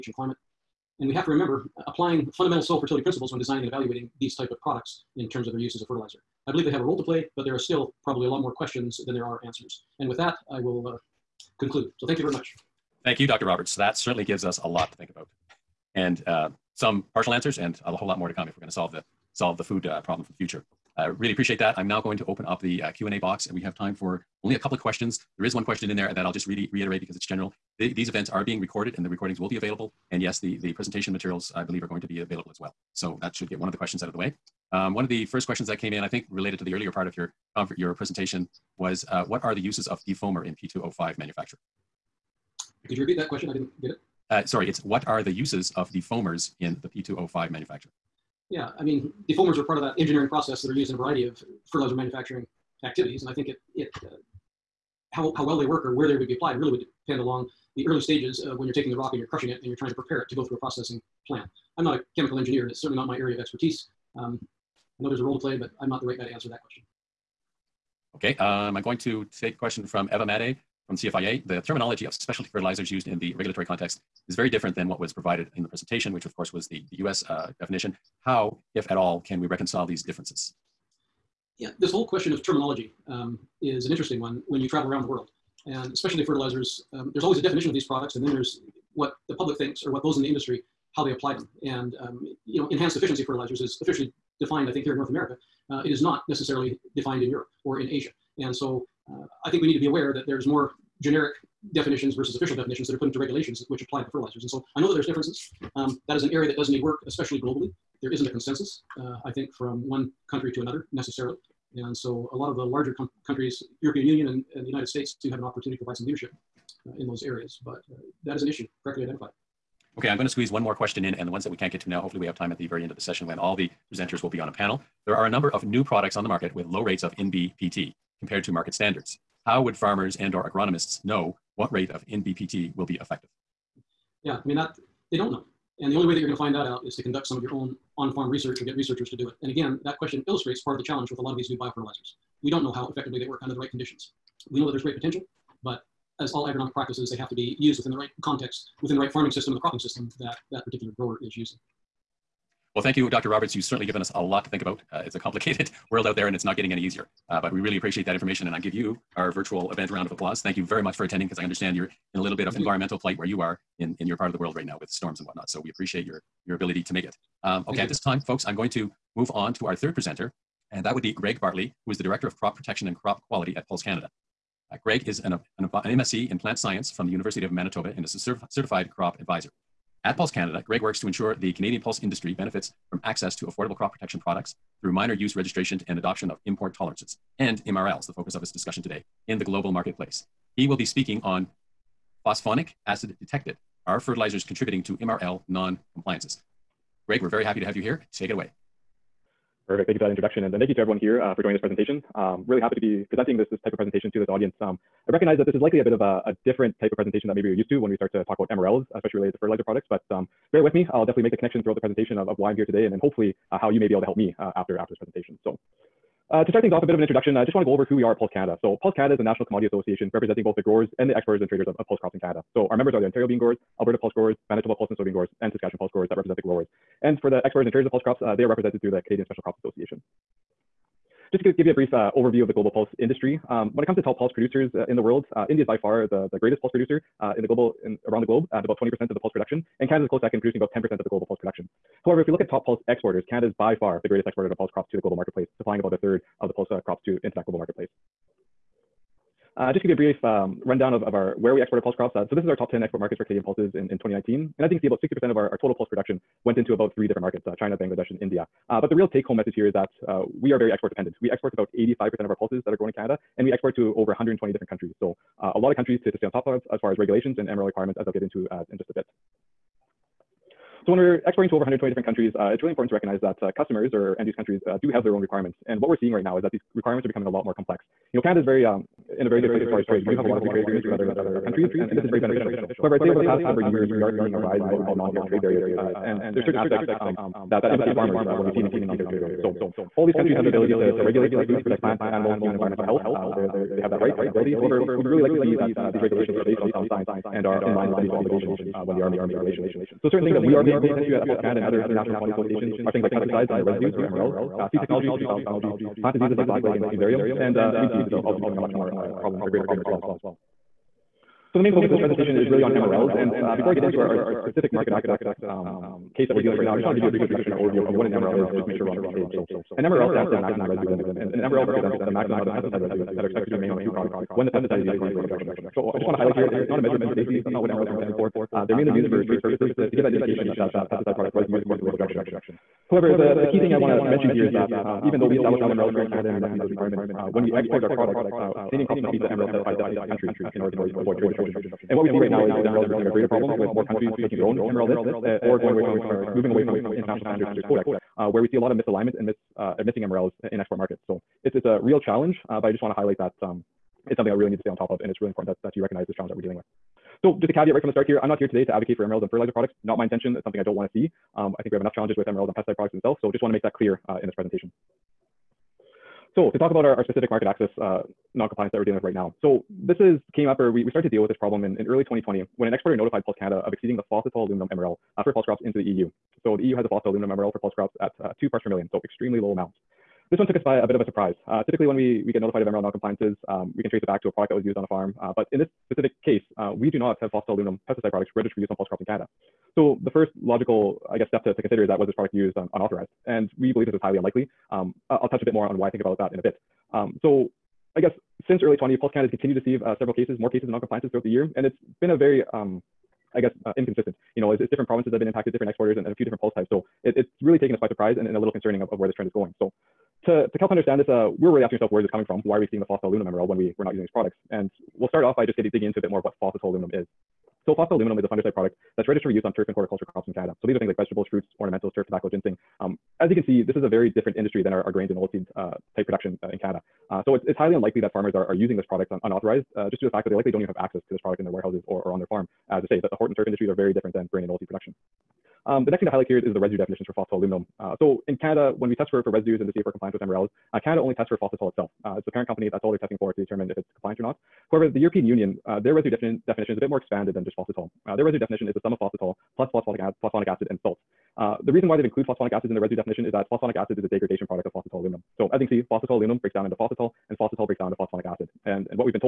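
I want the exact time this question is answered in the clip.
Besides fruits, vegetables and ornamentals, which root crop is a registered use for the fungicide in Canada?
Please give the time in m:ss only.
7:02.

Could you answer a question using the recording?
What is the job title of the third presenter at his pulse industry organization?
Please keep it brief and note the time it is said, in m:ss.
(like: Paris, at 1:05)
Director of Crop Protection and Crop Quality, at 2:52.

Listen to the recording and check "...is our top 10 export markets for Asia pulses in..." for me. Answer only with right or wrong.
wrong.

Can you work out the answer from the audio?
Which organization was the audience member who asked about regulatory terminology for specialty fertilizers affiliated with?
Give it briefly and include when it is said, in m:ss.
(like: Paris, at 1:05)
CFIA, at 1:10.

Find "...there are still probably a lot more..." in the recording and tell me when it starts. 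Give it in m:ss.
0:07.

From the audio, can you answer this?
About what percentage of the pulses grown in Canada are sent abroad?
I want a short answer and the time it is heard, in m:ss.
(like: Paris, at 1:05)
85%, at 4:21.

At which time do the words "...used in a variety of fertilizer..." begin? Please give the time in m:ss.
0:50.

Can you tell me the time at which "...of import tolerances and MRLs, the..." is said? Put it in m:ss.
3:06.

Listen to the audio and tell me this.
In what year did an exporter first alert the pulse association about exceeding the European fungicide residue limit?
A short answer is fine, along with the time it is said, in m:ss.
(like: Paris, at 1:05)
2020, at 6:12.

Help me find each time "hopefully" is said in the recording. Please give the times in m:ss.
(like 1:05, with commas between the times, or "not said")
2:02, 3:33.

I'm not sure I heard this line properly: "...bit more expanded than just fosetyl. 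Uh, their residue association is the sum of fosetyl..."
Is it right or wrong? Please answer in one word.
wrong.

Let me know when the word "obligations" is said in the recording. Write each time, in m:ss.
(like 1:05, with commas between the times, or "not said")
4:58.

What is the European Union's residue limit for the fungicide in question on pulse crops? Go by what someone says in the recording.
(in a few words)
2 parts per million.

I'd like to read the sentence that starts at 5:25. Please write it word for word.
So I just want to highlight here, it, it's not a measure of food safety.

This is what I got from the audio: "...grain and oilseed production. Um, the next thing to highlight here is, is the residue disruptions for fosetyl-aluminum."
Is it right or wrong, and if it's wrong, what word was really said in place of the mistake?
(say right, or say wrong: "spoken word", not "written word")
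wrong: "definitions", not "disruptions".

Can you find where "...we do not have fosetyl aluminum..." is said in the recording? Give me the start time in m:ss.
6:26.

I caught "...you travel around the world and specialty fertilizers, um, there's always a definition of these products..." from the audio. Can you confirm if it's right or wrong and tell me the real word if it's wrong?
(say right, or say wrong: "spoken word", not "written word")
right.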